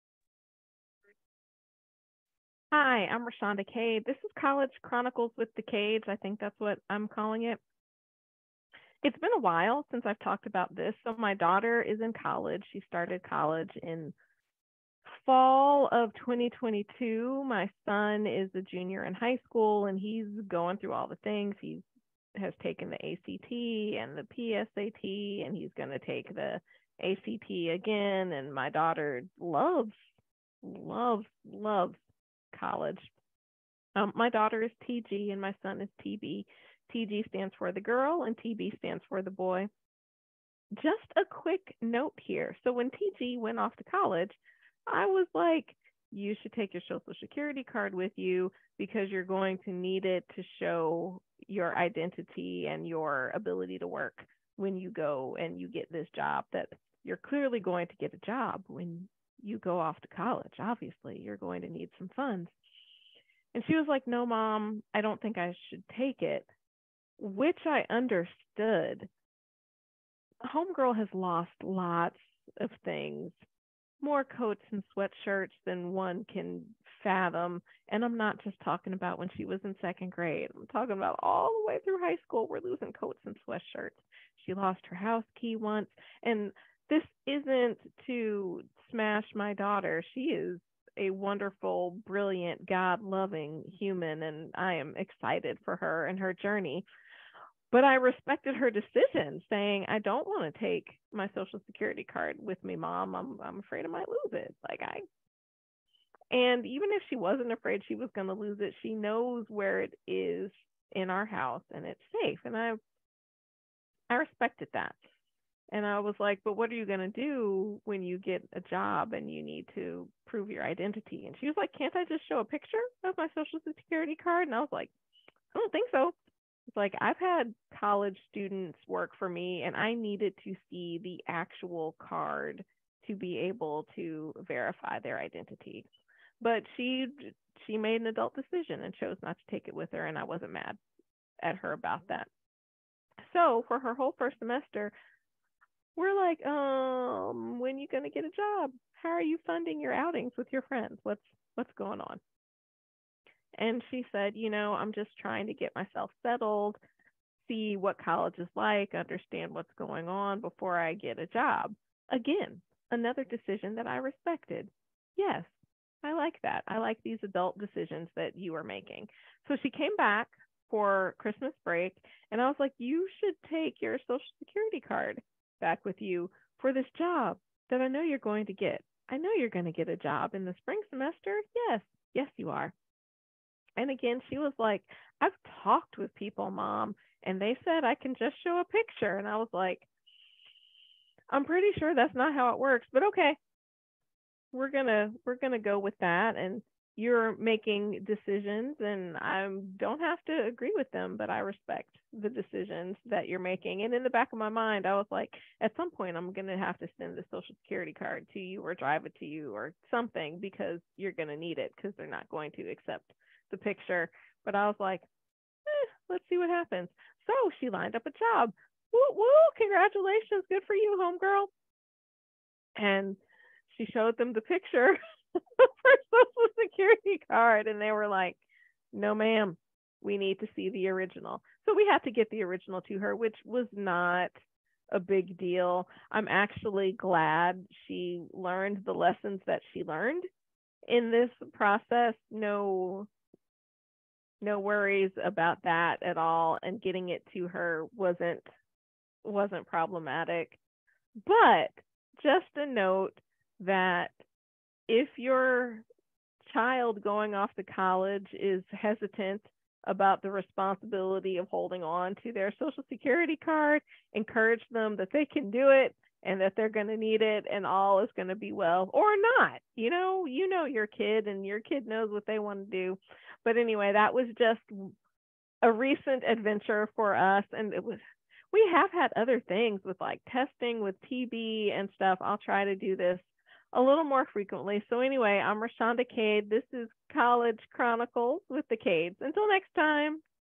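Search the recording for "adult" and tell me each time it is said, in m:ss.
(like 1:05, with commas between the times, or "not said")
2:18, 2:47.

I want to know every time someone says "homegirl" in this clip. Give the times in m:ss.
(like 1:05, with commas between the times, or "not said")
1:10, 3:41.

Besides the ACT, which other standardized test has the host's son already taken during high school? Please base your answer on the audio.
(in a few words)
PSAT.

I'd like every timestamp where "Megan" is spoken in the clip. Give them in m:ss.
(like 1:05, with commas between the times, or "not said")
not said.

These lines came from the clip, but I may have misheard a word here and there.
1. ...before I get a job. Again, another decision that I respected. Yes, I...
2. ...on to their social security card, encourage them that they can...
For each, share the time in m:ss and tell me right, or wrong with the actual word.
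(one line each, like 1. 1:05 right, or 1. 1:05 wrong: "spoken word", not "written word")
1. 2:40 right
2. 4:21 right.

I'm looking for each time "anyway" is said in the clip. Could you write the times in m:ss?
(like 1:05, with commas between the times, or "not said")
4:33, 4:44.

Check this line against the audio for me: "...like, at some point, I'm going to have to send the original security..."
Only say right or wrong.
wrong.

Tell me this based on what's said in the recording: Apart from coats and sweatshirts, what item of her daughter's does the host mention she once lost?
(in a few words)
her house key.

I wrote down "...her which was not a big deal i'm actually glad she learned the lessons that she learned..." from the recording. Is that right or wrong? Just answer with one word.
right.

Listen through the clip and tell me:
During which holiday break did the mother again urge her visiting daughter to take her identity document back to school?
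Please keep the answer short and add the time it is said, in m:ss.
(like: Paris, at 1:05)
Christmas break, at 2:51.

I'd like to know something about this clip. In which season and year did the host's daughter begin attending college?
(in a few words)
fall of 2022.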